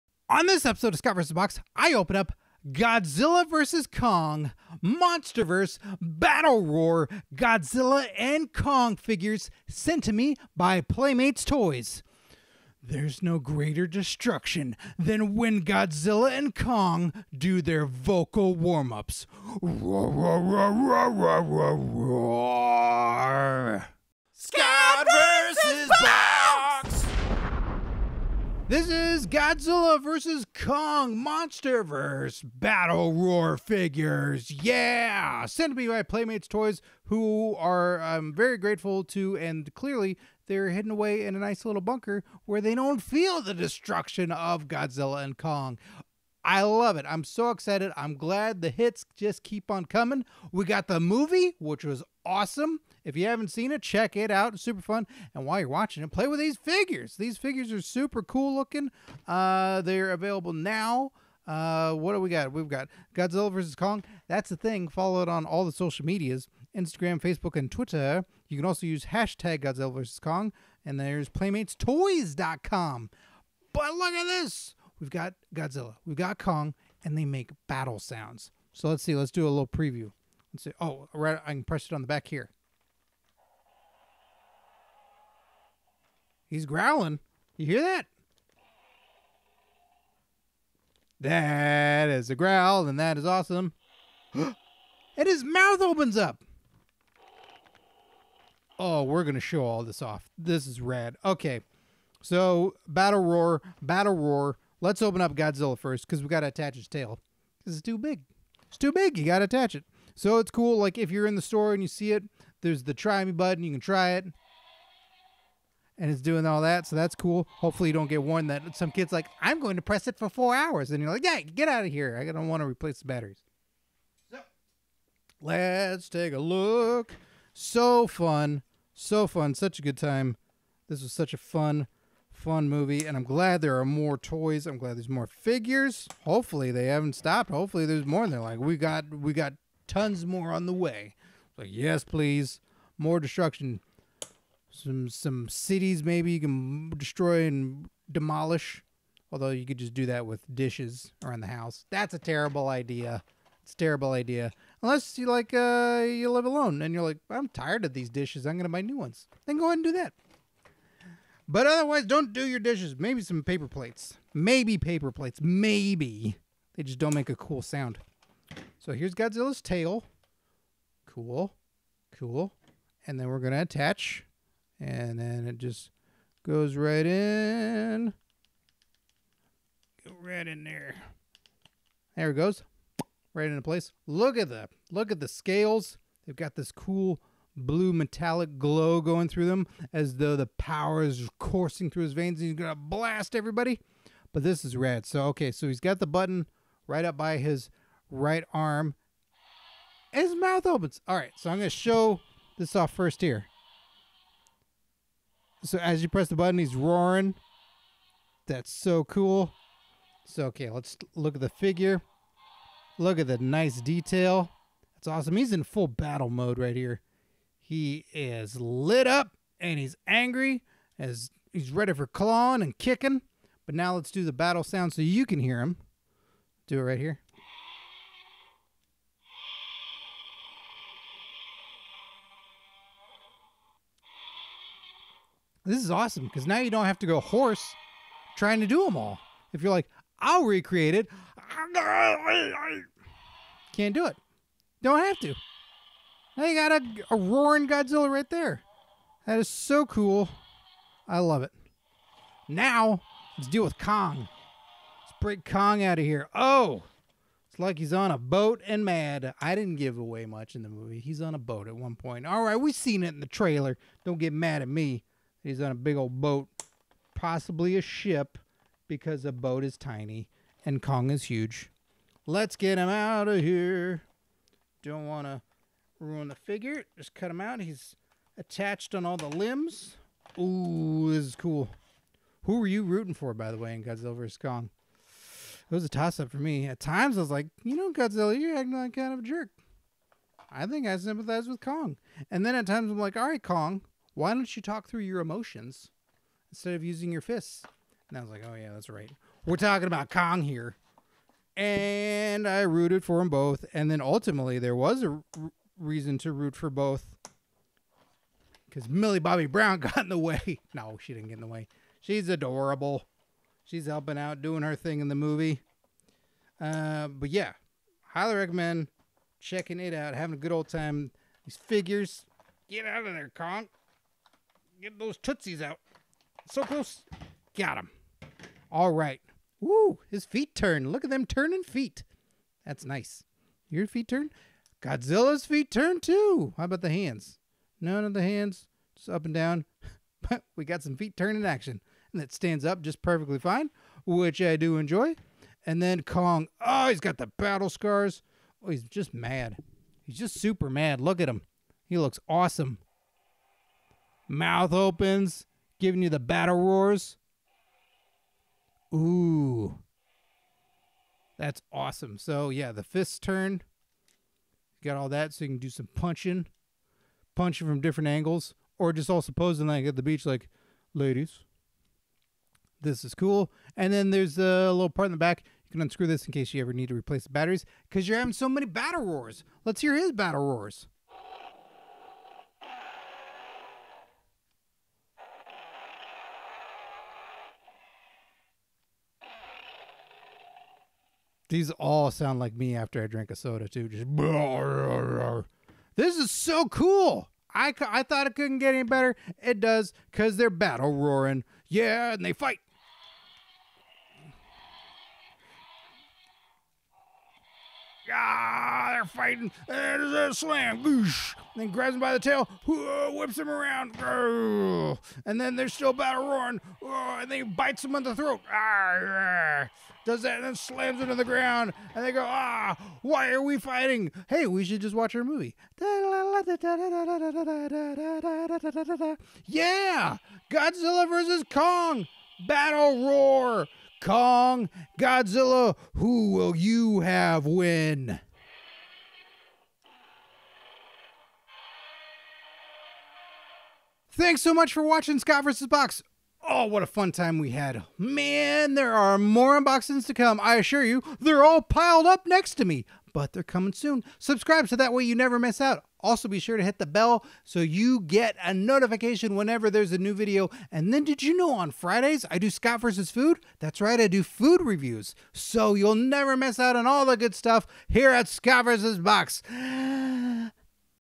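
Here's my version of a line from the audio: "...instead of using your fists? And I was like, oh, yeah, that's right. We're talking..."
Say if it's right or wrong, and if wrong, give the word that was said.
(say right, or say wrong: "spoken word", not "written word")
right.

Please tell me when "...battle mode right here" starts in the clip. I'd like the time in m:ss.
3:35.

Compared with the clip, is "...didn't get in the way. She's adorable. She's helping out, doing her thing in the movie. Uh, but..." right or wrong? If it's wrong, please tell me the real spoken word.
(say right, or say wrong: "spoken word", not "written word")
right.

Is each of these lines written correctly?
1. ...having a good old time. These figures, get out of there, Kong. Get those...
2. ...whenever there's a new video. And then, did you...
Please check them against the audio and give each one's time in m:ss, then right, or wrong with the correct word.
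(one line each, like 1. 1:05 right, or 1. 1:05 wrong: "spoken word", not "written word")
1. 5:20 right
2. 7:39 right.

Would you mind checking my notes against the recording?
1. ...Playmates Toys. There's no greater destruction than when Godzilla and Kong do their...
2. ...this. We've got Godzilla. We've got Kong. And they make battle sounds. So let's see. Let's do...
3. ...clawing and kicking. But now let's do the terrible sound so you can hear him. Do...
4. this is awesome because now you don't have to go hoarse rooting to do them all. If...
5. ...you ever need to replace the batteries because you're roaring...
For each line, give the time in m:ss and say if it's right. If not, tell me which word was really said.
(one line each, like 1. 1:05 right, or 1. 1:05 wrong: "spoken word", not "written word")
1. 0:10 right
2. 1:14 right
3. 3:42 wrong: "battle", not "terrible"
4. 3:55 wrong: "trying", not "rooting"
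5. 6:16 wrong: "having", not "roaring".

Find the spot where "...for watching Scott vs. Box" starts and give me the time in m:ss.
7:24.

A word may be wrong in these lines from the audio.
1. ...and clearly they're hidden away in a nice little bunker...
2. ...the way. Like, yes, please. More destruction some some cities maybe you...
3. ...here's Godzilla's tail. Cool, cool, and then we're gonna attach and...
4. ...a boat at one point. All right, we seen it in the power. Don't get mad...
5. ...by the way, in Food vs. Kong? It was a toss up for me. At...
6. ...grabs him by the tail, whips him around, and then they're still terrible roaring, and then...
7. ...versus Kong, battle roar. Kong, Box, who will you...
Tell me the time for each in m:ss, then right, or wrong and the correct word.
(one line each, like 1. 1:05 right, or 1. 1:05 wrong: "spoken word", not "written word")
1. 0:39 right
2. 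2:20 right
3. 2:48 right
4. 4:21 wrong: "trailer", not "power"
5. 4:43 wrong: "Godzilla", not "Food"
6. 6:51 wrong: "battle", not "terrible"
7. 7:11 wrong: "Godzilla", not "Box".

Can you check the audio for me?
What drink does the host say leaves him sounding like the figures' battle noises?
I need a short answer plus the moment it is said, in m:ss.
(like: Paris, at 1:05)
soda, at 6:33.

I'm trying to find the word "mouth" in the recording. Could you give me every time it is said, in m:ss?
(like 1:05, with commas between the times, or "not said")
1:35, 3:20, 5:54.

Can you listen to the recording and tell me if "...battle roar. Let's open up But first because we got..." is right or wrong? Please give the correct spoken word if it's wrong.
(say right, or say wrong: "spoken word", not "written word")
wrong: "Godzilla", not "But".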